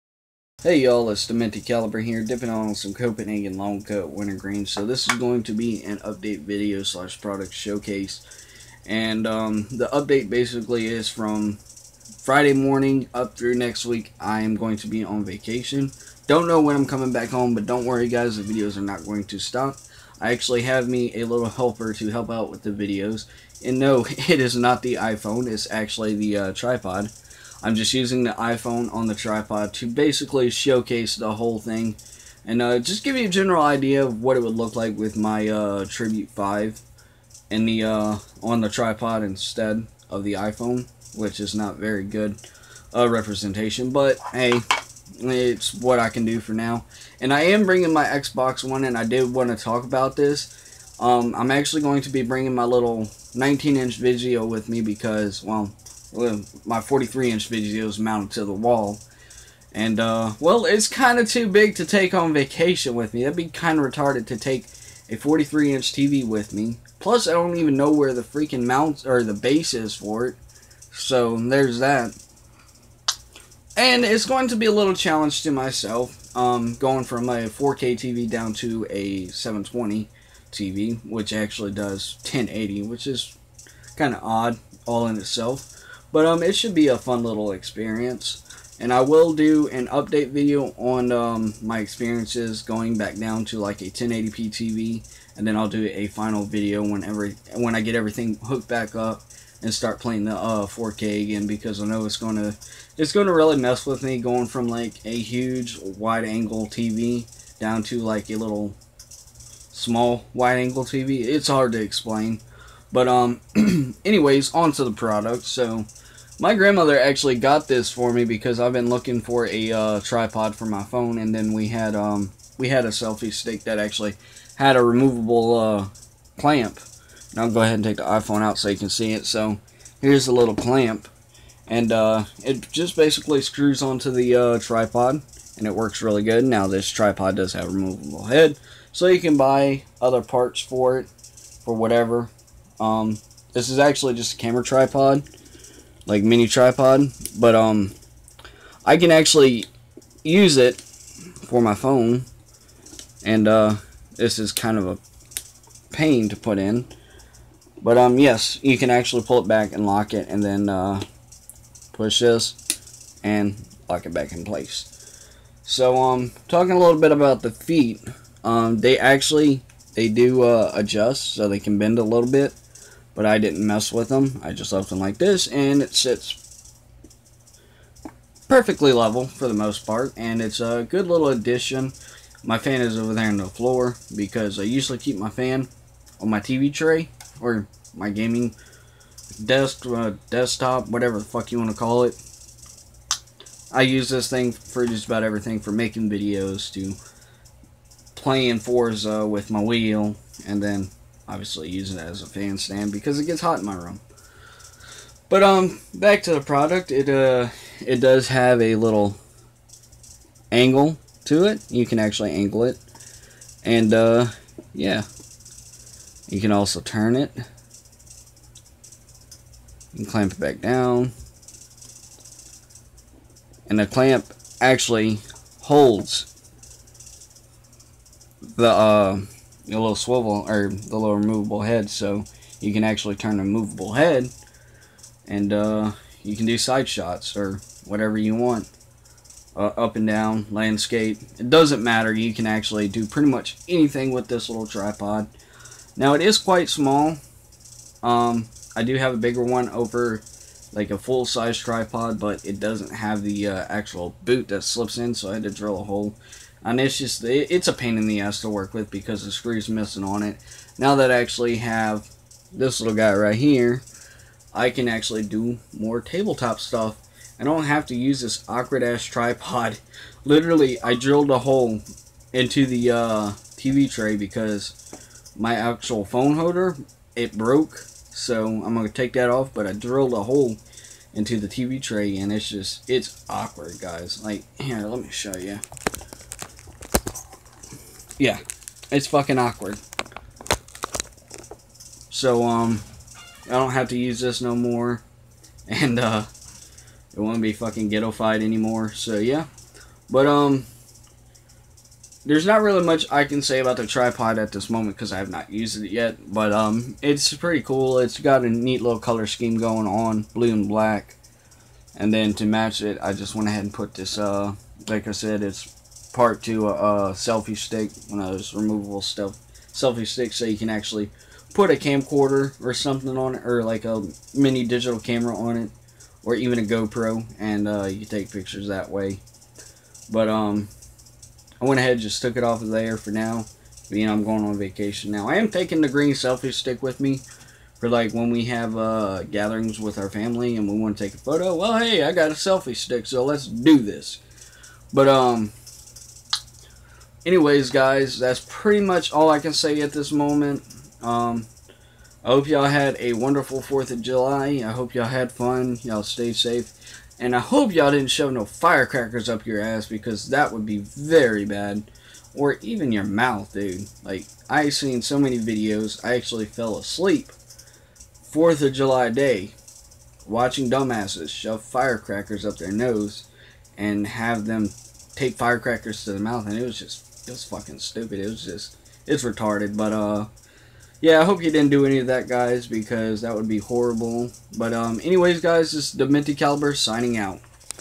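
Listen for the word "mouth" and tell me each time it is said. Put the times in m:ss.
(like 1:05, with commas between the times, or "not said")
6:03, 6:16.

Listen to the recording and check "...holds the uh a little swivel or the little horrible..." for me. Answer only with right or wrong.
wrong.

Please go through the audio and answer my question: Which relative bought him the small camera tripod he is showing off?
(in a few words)
grandmother.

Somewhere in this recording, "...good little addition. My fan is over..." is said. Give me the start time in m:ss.
3:00.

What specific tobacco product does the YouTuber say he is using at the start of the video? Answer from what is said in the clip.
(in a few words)
Copenhagen Long Cut Wintergreen.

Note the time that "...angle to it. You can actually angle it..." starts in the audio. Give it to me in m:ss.
3:30.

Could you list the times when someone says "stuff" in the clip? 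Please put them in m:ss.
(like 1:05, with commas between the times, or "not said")
4:26, 5:19.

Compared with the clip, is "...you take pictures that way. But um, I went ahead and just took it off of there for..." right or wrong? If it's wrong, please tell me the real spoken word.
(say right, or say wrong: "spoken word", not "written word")
right.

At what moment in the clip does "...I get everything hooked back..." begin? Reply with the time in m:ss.
1:37.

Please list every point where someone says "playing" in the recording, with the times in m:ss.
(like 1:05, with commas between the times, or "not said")
1:39, 3:18.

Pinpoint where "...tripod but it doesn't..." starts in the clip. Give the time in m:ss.
4:11.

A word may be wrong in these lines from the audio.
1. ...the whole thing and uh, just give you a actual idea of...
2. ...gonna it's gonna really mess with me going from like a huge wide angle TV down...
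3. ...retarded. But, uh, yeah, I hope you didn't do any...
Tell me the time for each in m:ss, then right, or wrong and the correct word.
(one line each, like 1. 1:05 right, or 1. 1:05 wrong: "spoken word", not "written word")
1. 0:31 wrong: "general", not "actual"
2. 1:42 right
3. 6:19 right.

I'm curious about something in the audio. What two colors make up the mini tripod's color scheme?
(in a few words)
blue and black.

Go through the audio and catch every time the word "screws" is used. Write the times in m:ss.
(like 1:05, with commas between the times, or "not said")
2:13, 4:19.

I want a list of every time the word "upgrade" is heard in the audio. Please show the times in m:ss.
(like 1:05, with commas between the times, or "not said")
not said.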